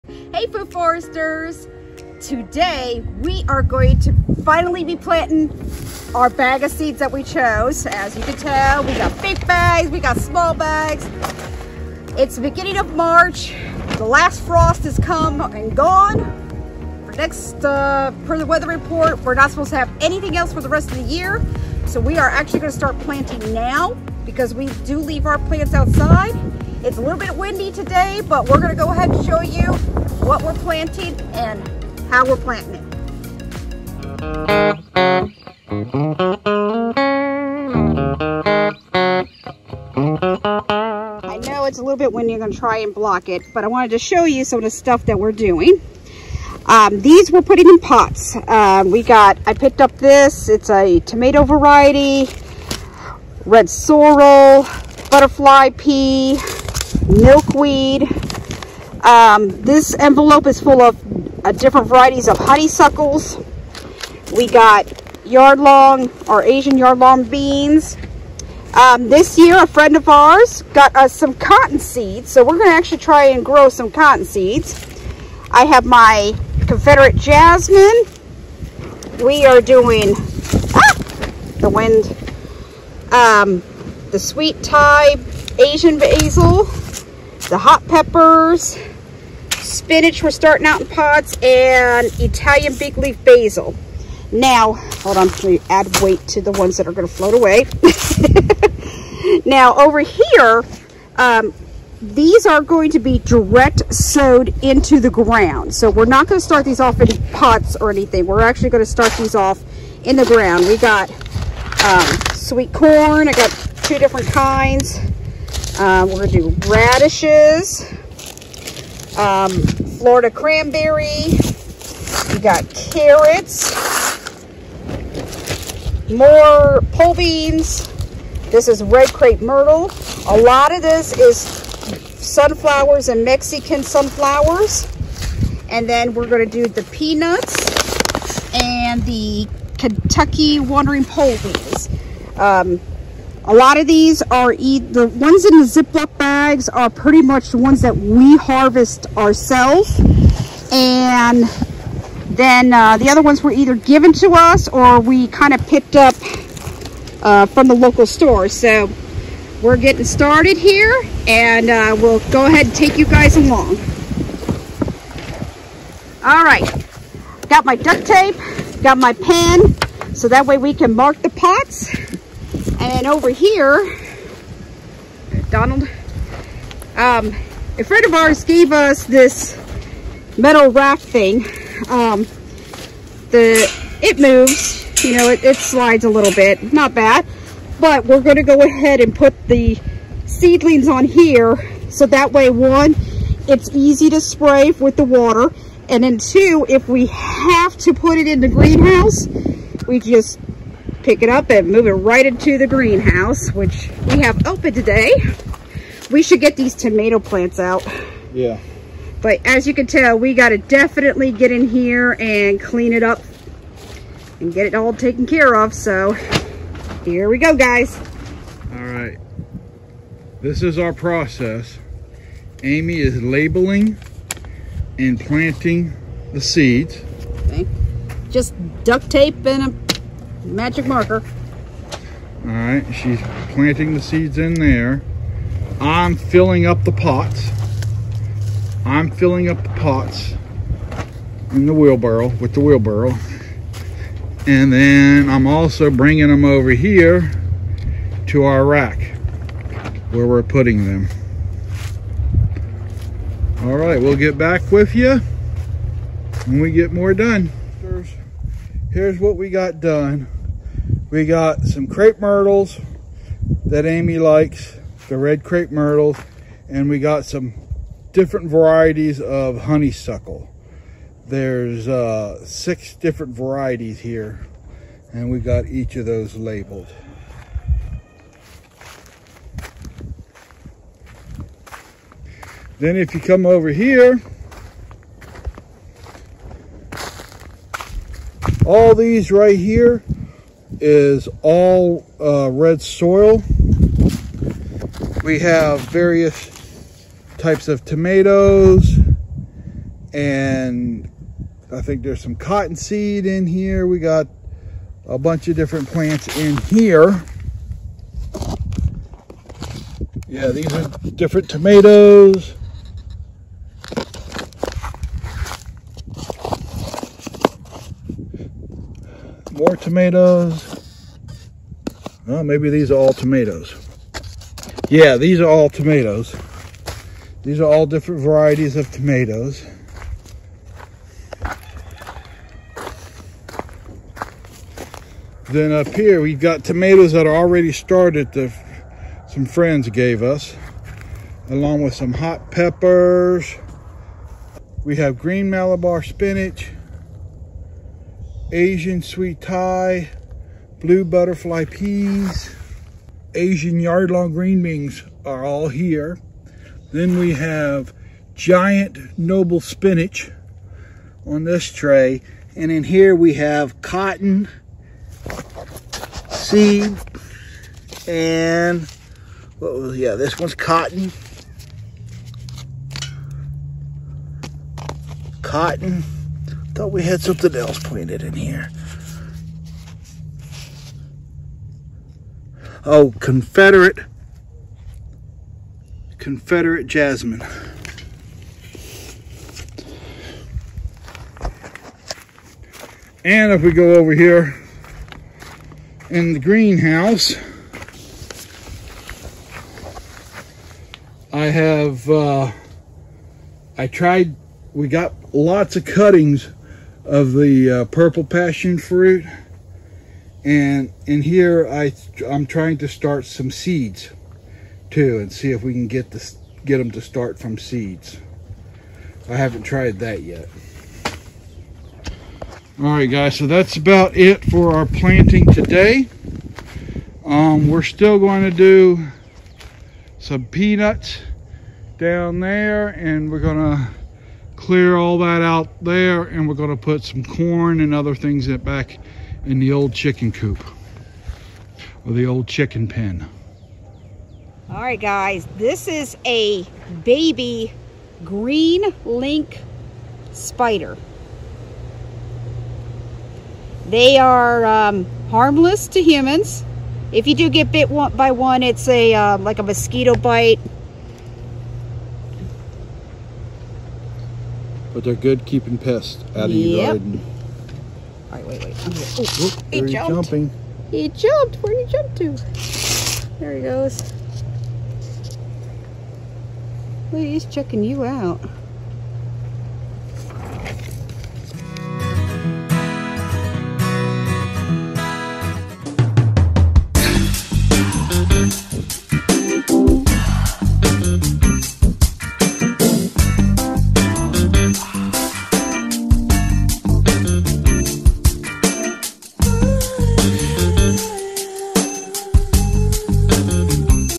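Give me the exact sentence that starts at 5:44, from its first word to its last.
We have green Malabar spinach, Asian sweet Thai, blue butterfly peas, Asian yard-long green beans are all here.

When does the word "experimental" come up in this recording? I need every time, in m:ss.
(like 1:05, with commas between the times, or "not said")
not said.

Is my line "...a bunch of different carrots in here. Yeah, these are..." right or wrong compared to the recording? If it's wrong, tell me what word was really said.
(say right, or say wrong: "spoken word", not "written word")
wrong: "plants", not "carrots".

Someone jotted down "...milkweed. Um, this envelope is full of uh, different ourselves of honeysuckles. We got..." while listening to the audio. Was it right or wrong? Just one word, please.
wrong.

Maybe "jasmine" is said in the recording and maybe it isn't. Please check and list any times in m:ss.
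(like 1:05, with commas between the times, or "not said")
1:17, 6:26.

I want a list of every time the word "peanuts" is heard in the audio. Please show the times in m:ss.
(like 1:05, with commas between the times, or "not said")
2:16, 7:10.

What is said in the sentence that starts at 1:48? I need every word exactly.
We're actually going to start these off in the ground.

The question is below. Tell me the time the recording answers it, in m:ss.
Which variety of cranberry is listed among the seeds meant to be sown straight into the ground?
1:59.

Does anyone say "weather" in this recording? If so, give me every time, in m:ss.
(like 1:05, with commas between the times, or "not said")
0:18.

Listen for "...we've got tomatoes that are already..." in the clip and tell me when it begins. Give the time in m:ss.
5:36.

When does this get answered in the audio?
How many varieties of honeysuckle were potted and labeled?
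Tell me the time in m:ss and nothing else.
4:32.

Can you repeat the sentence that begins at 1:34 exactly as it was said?
Now, hold on, we add weight to the ones that are going to float away.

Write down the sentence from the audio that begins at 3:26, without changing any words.
We should get these tomato plants out.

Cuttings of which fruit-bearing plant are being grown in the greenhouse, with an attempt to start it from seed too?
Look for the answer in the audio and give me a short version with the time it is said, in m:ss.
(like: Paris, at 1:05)
Purple passion fruit, at 6:47.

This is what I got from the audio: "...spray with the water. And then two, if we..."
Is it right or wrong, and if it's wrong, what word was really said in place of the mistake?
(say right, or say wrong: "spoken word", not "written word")
right.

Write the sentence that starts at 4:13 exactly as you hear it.
All right, we'll get back with you when we get more done.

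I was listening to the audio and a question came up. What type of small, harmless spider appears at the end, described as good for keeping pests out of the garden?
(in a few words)
Green lynx spider.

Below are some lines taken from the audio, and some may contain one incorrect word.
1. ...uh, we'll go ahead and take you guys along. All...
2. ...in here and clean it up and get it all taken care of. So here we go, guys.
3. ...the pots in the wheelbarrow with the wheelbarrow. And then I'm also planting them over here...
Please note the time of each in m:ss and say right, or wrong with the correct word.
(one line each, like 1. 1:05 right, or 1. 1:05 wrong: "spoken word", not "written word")
1. 2:41 right
2. 3:31 right
3. 3:59 wrong: "bringing", not "planting".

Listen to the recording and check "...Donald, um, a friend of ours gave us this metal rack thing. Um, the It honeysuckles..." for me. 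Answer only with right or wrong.
wrong.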